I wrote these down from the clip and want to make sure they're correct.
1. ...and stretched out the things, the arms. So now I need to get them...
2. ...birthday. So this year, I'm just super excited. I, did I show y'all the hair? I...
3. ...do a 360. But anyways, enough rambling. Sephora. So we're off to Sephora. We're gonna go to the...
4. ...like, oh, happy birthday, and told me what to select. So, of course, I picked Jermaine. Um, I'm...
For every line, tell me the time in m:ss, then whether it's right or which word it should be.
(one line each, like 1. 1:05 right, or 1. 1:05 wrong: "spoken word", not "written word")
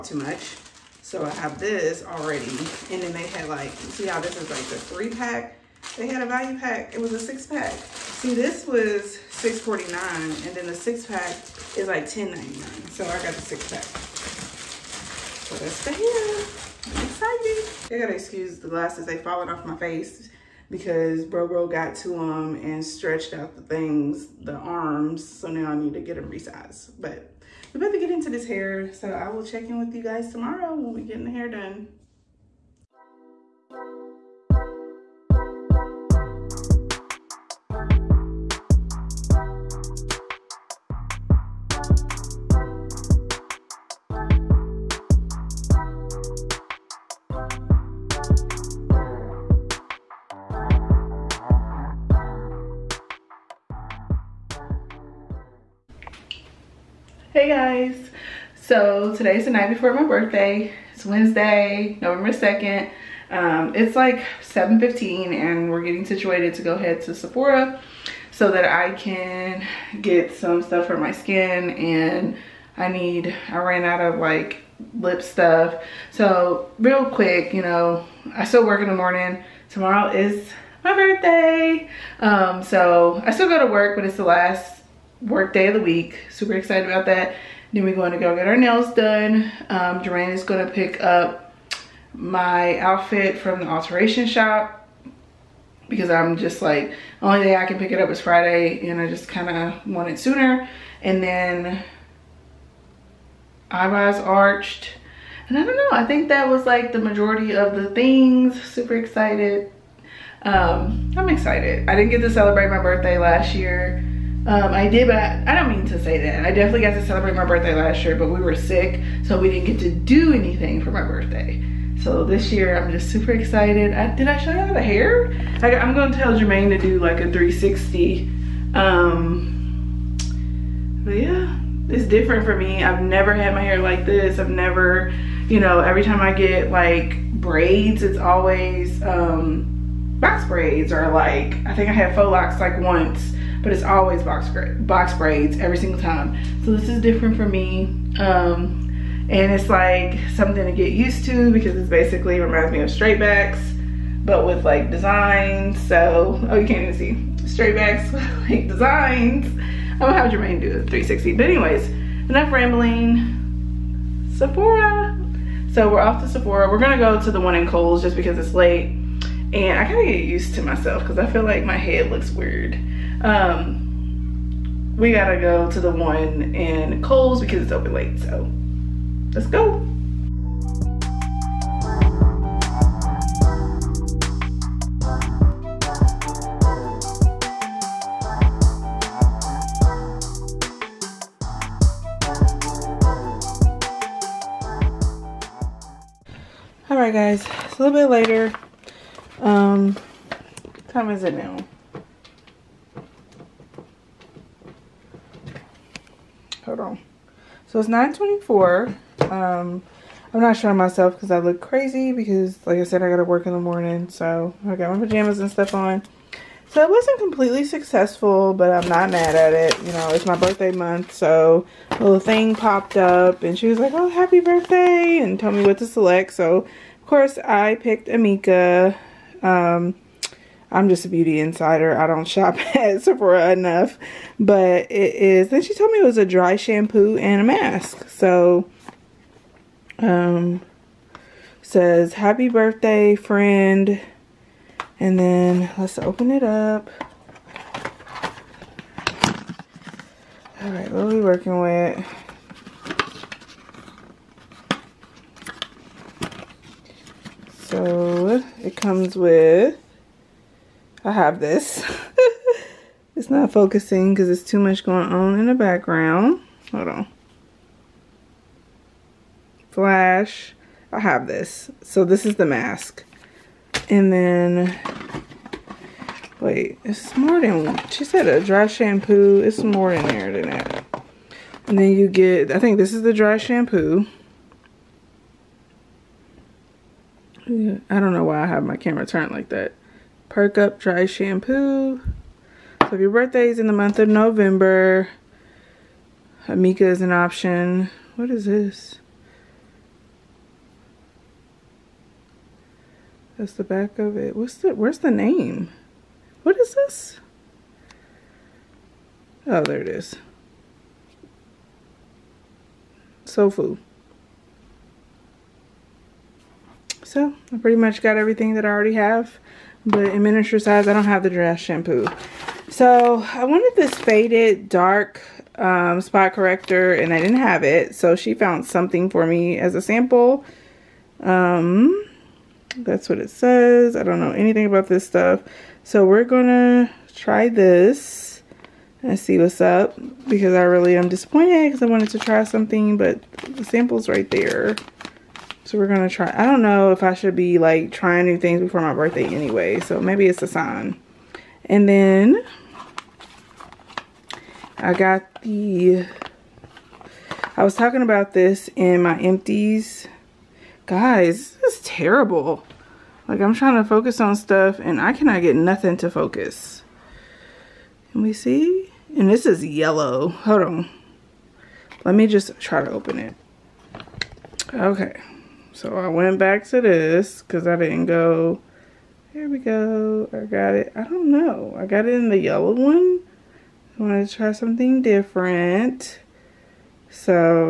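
1. 0:22 right
2. 2:01 right
3. 2:40 right
4. 3:43 wrong: "Amika", not "Jermaine".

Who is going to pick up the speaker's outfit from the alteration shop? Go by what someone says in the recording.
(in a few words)
Duran.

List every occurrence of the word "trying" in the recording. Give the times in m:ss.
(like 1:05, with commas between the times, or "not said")
5:47, 6:03.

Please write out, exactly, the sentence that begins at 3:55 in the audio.
Then she told me it was a dry shampoo and a mask.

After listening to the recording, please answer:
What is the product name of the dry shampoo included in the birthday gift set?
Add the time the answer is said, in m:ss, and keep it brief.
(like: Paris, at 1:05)
Perk Up, at 4:50.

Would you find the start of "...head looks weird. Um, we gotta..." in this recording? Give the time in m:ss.
2:51.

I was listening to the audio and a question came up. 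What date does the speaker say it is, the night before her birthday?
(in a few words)
November 2nd.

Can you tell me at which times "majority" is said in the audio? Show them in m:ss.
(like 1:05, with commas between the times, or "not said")
1:46.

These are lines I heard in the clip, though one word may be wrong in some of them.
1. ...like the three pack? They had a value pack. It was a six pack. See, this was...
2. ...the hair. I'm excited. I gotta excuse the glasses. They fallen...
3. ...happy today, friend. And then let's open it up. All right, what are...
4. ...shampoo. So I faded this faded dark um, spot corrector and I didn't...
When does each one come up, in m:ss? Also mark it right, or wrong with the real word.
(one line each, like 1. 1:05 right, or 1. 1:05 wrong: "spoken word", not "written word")
1. 0:04 right
2. 0:15 right
3. 4:02 wrong: "birthday", not "today"
4. 5:21 wrong: "wanted", not "faded".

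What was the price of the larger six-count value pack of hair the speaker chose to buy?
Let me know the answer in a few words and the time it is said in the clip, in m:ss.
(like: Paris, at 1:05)
$10.99, at 0:12.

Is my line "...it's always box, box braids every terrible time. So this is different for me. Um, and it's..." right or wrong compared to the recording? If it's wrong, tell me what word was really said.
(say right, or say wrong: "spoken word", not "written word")
wrong: "single", not "terrible".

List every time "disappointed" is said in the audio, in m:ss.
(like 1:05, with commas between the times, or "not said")
5:41.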